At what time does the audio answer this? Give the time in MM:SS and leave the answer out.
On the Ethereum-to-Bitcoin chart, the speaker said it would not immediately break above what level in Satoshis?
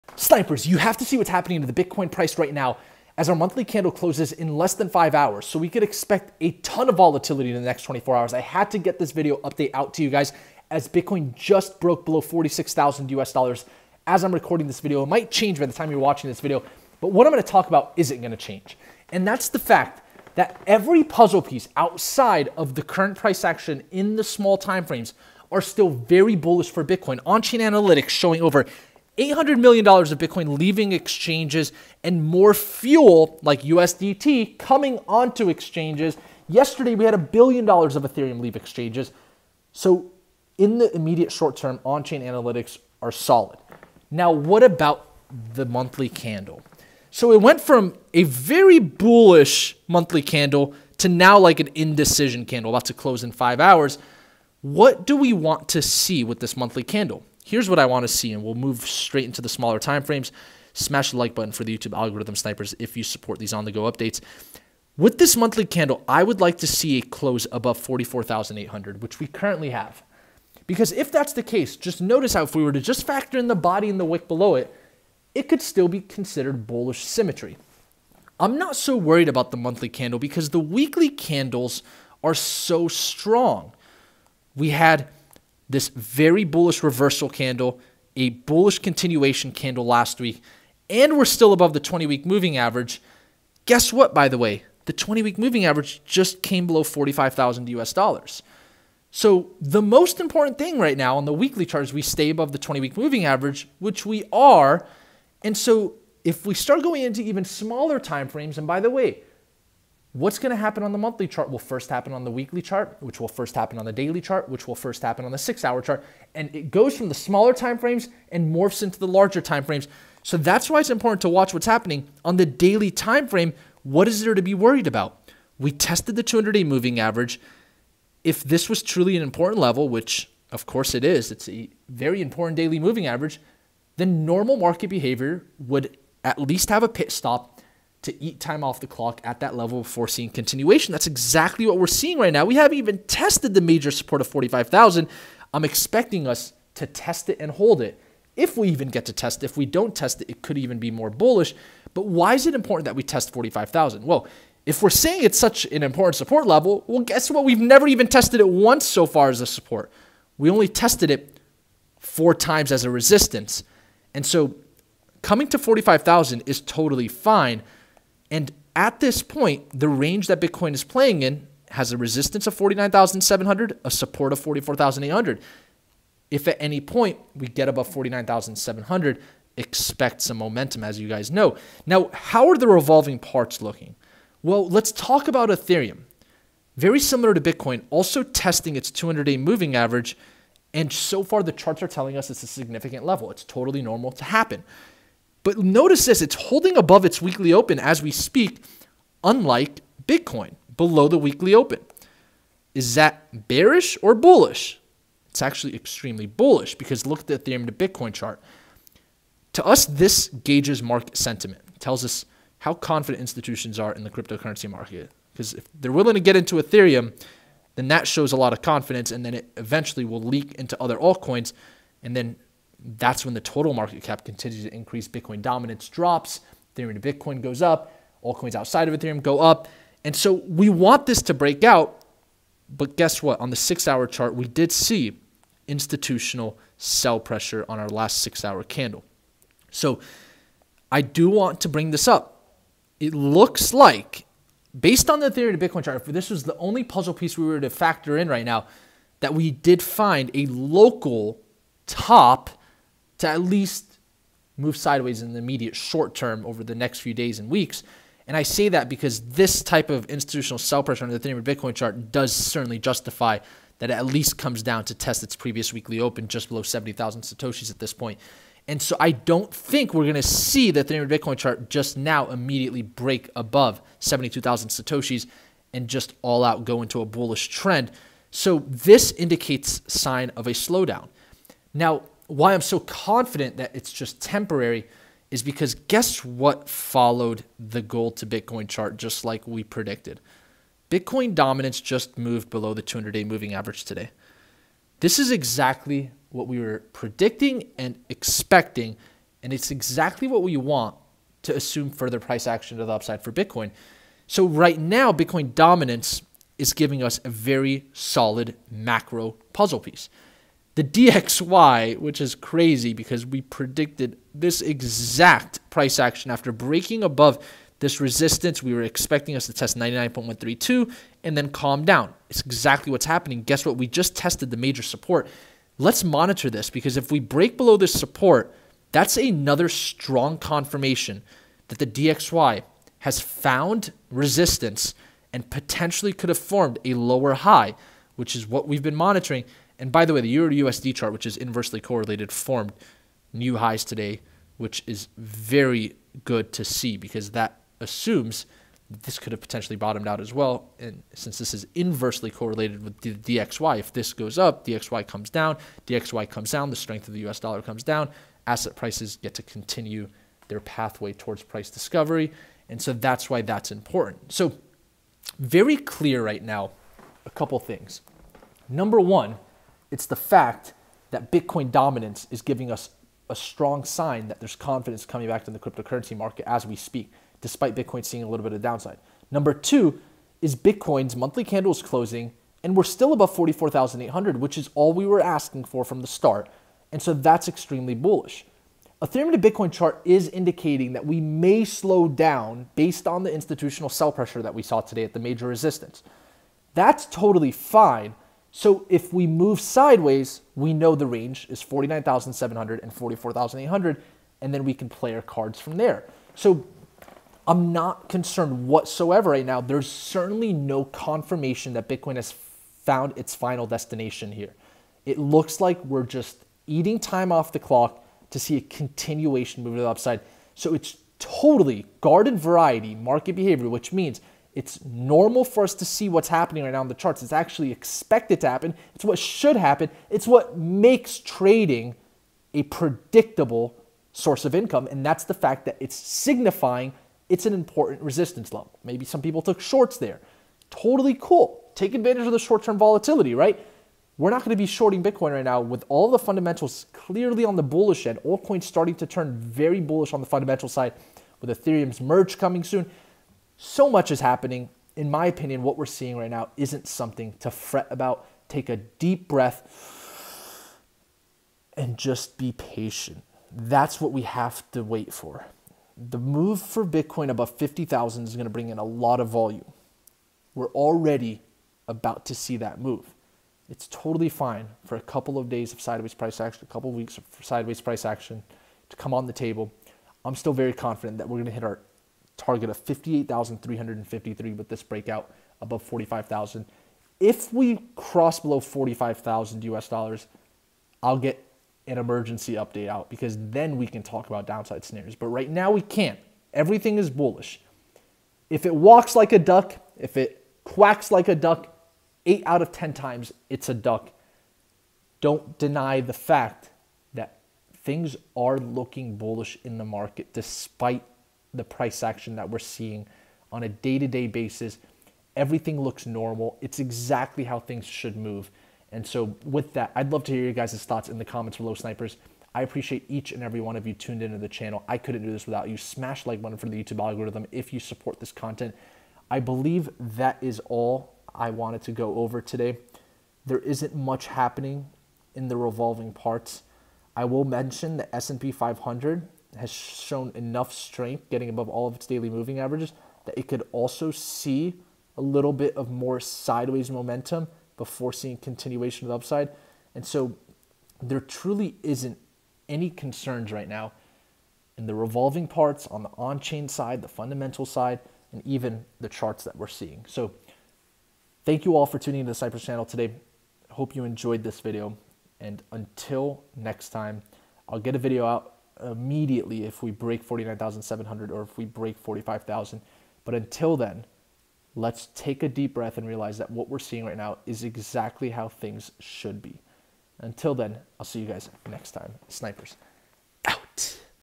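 04:33.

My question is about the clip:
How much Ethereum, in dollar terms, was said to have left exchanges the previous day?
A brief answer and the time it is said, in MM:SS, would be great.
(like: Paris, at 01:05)
$1 billion, at 00:37.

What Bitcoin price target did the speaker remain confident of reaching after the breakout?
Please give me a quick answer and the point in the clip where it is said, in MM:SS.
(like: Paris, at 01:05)
58,353, at 08:02.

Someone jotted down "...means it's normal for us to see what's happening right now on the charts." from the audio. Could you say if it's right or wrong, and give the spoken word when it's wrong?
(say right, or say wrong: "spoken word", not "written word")
right.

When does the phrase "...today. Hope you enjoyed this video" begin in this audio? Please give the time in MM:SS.
09:22.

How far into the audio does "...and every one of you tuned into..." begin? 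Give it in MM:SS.
08:43.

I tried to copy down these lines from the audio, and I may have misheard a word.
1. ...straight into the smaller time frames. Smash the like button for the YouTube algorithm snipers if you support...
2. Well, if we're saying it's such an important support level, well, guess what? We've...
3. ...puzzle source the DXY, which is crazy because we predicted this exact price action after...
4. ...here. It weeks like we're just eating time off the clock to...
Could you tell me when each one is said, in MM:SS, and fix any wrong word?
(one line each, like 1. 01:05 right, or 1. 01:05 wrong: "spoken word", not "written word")
1. 00:58 right
2. 02:34 right
3. 05:09 wrong: "piece", not "source"
4. 06:54 wrong: "looks", not "weeks".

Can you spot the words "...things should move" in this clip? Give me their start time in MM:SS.
08:37.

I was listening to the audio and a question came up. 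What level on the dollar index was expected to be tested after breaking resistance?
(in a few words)
99.132.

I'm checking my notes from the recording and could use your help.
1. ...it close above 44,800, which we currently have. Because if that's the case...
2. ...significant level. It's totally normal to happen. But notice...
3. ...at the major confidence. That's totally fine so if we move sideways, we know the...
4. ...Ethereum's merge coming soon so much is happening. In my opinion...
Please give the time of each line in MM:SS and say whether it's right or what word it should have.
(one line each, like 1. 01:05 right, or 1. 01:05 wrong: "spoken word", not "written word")
1. 01:06 right
2. 03:12 right
3. 06:35 wrong: "resistance", not "confidence"
4. 07:31 right.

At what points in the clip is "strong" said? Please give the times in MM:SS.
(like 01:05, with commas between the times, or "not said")
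01:22, 05:29, 06:13.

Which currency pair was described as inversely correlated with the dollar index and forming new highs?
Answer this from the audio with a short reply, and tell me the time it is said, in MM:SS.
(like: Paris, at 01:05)
Euro USD, at 05:40.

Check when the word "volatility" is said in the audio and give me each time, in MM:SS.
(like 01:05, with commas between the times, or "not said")
00:06, 07:22.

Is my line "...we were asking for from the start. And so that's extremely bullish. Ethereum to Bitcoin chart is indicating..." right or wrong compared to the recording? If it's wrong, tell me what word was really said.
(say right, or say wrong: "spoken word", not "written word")
right.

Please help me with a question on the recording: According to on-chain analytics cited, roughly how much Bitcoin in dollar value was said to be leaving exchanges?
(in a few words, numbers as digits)
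$800 million.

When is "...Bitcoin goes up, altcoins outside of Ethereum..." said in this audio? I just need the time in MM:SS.
03:47.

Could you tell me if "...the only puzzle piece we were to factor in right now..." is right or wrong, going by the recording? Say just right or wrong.
right.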